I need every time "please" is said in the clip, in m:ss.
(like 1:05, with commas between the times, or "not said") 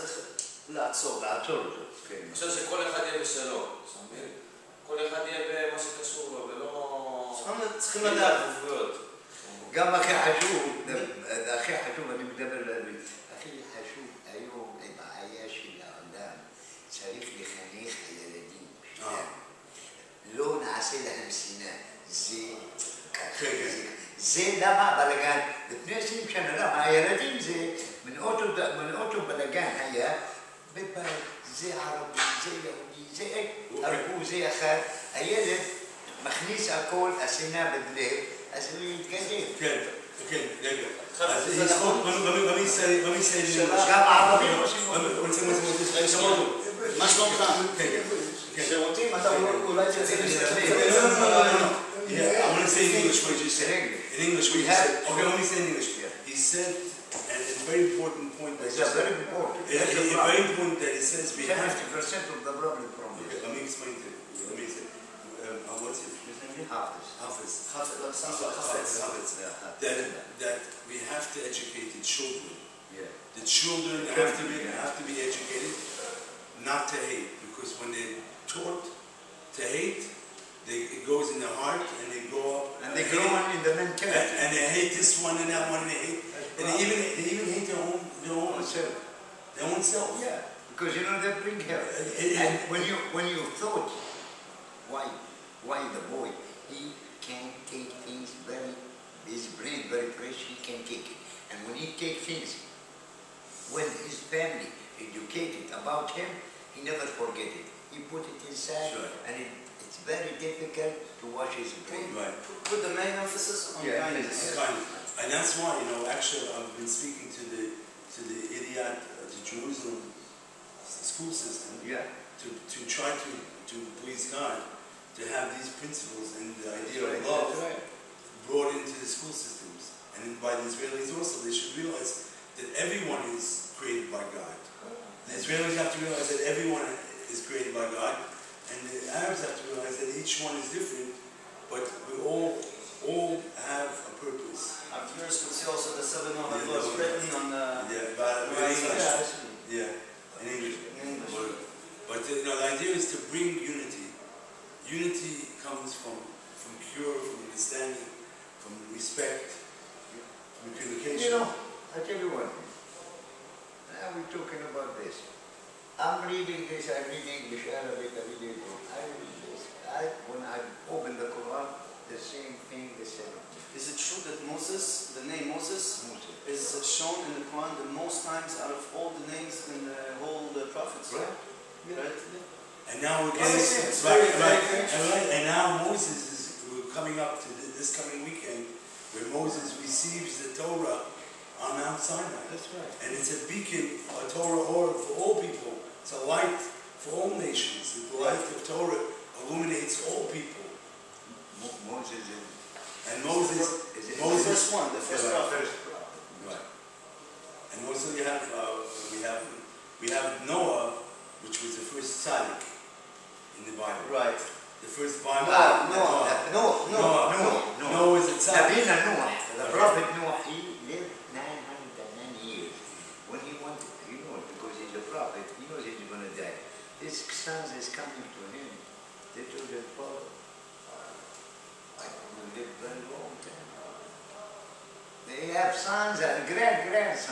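2:04.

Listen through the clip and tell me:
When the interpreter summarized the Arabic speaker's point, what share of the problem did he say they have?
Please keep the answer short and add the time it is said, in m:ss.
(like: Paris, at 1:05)
50%, at 1:01.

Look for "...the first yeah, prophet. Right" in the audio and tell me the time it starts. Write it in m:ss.
3:24.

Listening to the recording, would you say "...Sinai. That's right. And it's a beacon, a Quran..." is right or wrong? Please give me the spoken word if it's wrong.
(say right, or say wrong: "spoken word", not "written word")
wrong: "Torah", not "Quran".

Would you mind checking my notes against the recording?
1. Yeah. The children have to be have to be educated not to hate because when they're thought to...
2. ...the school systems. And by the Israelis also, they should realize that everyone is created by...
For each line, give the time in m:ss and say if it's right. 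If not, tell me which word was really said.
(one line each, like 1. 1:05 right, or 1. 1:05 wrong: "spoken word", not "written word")
1. 1:12 wrong: "taught", not "thought"
2. 2:08 right.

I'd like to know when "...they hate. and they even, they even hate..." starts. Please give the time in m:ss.
1:25.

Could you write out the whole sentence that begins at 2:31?
But, but you know, the idea is to bring unity.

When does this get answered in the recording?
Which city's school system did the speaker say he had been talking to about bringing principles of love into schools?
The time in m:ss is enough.
1:59.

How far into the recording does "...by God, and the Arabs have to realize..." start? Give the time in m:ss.
2:17.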